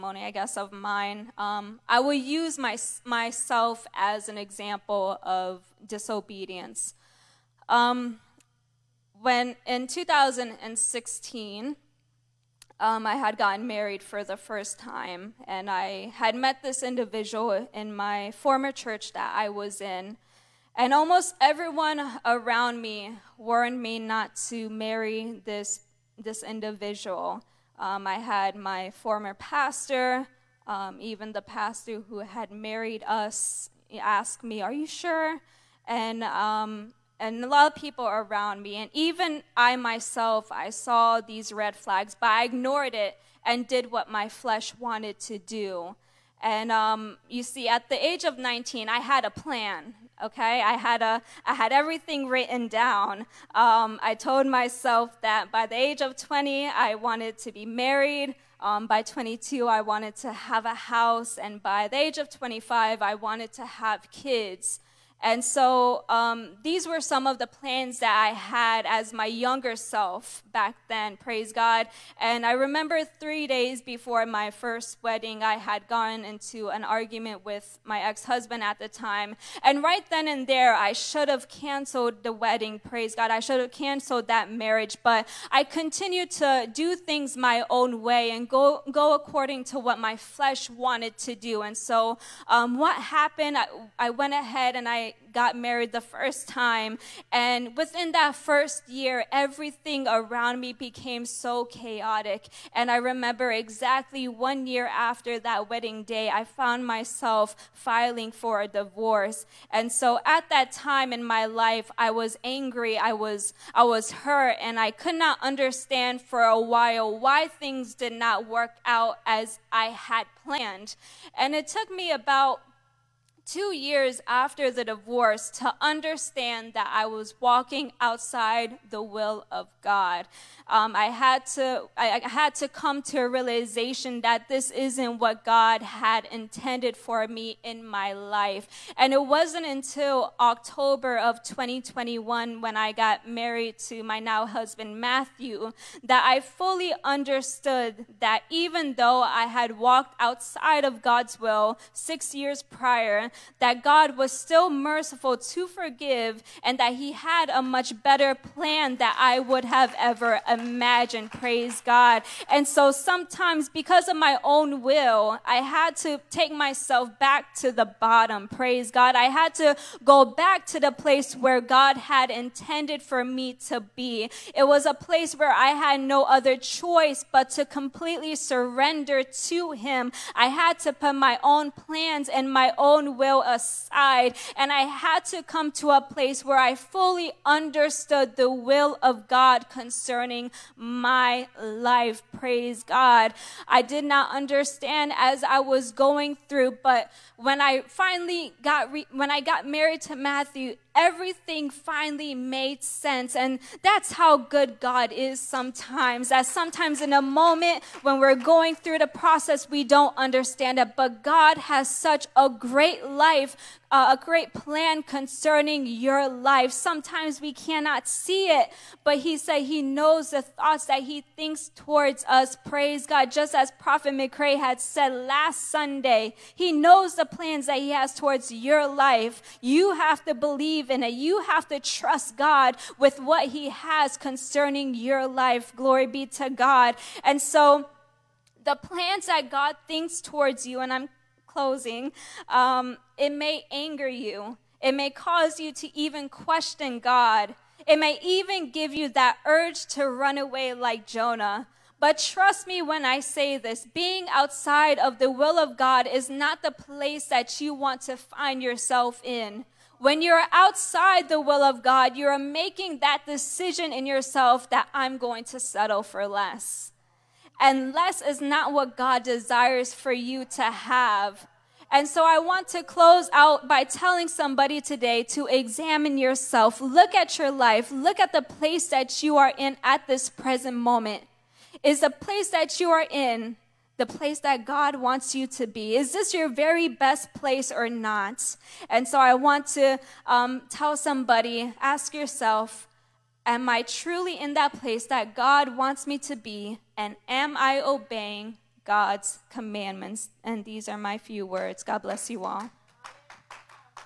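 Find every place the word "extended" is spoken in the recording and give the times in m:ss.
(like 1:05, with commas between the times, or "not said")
not said.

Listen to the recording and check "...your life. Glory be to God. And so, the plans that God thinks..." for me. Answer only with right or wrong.
right.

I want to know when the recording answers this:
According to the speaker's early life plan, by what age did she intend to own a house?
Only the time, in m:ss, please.
0:59.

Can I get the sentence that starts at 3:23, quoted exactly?
And that's how good God is sometimes.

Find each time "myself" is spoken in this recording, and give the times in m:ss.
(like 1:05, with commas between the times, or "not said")
0:03, 0:39, 0:54, 1:46, 2:46.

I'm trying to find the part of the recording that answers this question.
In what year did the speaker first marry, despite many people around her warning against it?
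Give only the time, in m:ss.
0:09.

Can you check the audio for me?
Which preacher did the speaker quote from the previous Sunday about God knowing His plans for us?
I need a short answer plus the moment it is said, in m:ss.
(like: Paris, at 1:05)
Prophet McRae, at 3:43.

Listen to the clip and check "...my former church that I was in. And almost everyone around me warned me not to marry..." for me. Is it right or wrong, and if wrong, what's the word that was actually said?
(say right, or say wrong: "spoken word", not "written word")
right.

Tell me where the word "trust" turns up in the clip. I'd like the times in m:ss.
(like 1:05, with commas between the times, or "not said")
3:51, 4:12.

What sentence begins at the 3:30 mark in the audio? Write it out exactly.
But God has such a great life uh, a great plan concerning your life.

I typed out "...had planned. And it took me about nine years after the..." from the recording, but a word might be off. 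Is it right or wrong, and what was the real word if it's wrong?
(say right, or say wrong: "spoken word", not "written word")
wrong: "two", not "nine".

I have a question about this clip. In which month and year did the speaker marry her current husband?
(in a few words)
October 2021.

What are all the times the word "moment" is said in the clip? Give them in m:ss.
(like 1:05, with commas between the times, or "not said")
3:27, 4:40.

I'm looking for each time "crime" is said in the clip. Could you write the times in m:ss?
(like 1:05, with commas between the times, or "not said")
not said.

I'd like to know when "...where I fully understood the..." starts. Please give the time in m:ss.
3:06.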